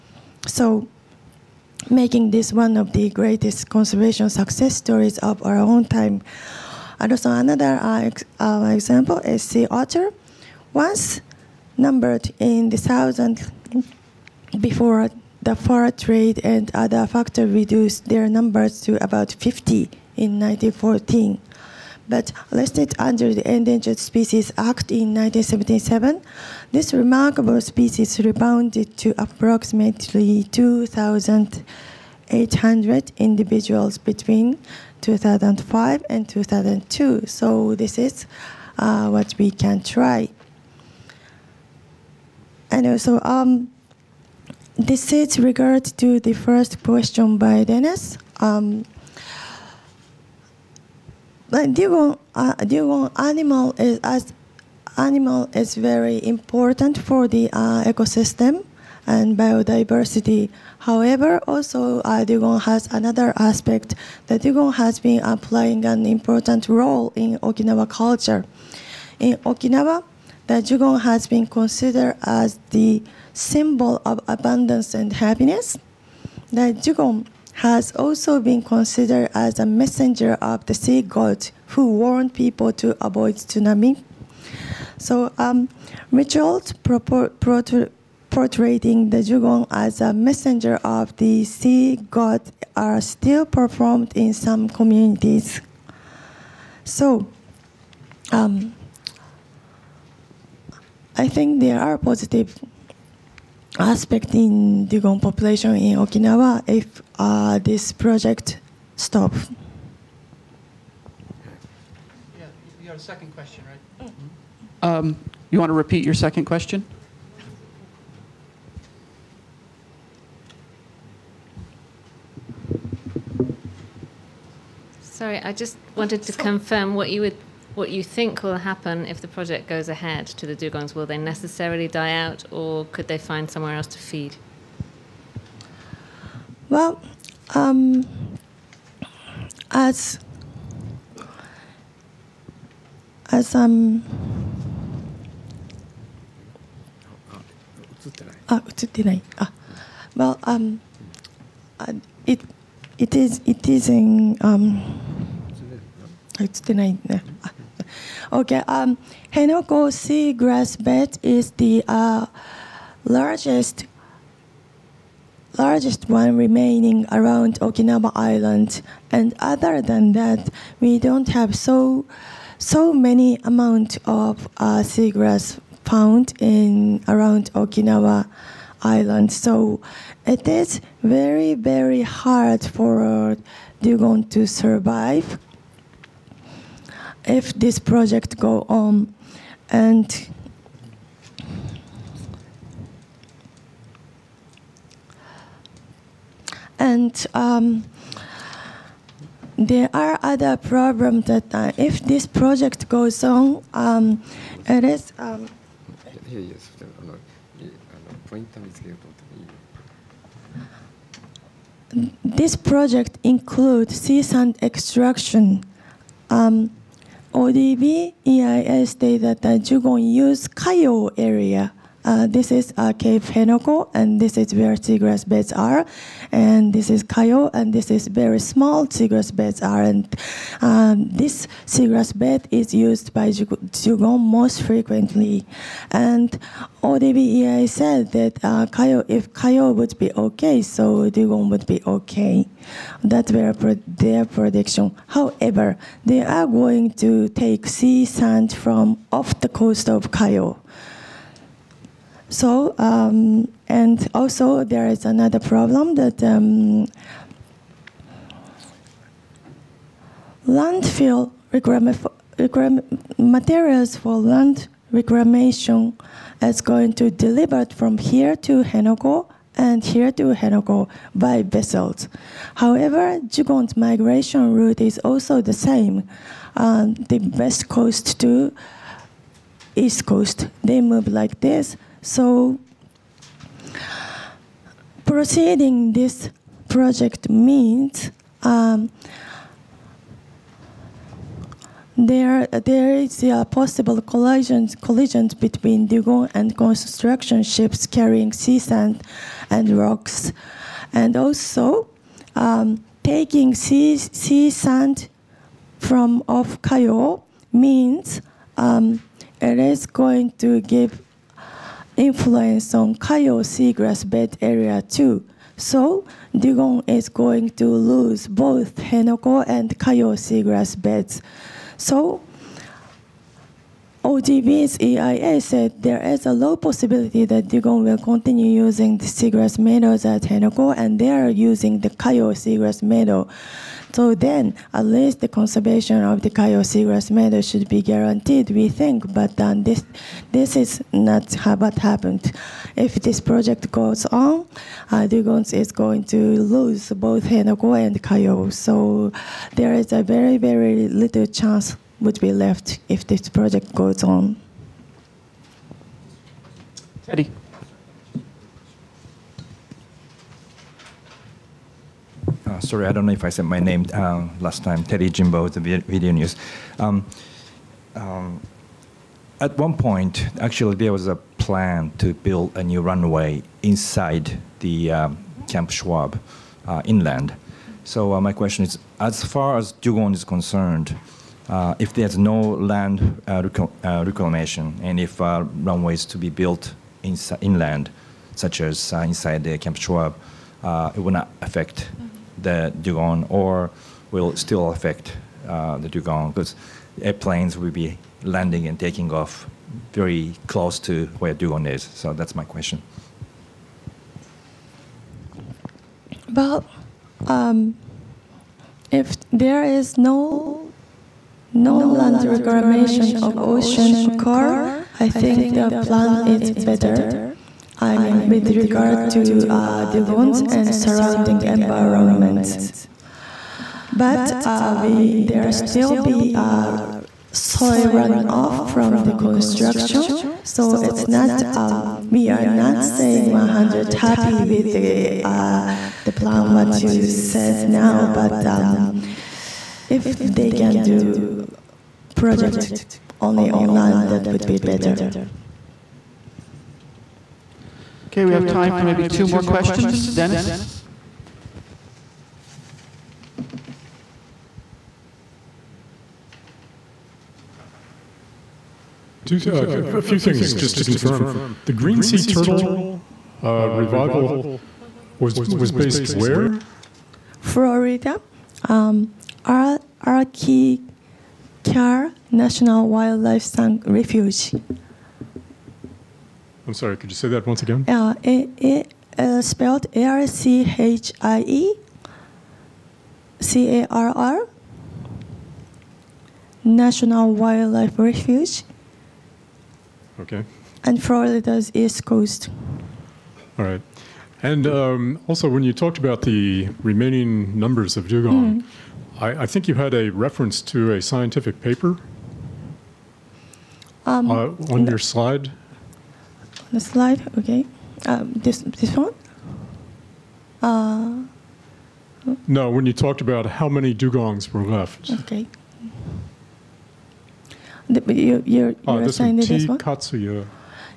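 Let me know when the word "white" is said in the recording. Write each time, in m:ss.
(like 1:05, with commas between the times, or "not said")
not said.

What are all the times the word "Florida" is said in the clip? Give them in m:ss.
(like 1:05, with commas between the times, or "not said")
7:47, 8:11.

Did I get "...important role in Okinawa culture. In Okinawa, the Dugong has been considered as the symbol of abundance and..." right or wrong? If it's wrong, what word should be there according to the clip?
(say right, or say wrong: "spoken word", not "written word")
right.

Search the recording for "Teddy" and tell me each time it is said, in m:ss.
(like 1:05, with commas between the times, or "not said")
6:04.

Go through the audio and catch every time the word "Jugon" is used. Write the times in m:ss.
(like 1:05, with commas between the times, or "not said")
3:39, 4:33.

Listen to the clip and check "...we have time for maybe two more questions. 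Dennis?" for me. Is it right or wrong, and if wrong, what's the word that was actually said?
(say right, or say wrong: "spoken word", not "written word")
right.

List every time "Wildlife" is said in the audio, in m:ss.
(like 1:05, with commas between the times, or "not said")
7:52, 8:07.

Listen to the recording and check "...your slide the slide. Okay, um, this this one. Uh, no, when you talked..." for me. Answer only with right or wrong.
right.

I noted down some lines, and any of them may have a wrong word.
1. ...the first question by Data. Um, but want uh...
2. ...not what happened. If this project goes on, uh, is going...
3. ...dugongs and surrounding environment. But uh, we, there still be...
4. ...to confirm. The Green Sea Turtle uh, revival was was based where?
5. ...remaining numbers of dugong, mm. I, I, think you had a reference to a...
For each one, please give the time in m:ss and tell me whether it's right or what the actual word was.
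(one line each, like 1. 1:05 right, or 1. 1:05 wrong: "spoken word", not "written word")
1. 0:46 wrong: "Dennis", not "Data"
2. 5:40 right
3. 6:59 right
4. 7:40 right
5. 8:16 right.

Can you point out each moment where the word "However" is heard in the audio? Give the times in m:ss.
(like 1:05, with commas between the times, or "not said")
1:00, 4:05, 4:32.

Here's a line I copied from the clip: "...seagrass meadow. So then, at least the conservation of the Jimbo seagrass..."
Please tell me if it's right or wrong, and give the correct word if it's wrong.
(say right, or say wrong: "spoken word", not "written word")
wrong: "Kayo", not "Jimbo".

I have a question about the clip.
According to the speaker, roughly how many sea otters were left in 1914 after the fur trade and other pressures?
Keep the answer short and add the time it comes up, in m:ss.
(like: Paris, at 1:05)
50, at 0:19.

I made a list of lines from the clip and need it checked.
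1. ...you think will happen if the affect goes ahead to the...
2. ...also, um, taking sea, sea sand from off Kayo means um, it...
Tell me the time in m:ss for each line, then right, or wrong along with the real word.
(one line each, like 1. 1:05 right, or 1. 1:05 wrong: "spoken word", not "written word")
1. 2:07 wrong: "project", not "affect"
2. 5:01 right.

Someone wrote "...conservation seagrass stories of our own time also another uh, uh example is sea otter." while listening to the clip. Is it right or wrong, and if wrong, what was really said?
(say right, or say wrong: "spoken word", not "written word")
wrong: "success", not "seagrass".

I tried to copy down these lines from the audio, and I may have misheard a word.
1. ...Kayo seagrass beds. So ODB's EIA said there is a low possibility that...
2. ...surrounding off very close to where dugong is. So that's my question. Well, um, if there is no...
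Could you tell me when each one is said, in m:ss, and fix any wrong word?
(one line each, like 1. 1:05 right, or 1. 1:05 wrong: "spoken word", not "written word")
1. 5:19 right
2. 6:38 wrong: "taking", not "surrounding".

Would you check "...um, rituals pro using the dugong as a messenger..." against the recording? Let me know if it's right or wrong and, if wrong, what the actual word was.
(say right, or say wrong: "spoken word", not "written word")
wrong: "portraying", not "using".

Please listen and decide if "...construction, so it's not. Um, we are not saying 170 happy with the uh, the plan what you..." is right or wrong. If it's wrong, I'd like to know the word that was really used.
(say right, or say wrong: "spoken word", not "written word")
wrong: "100", not "170".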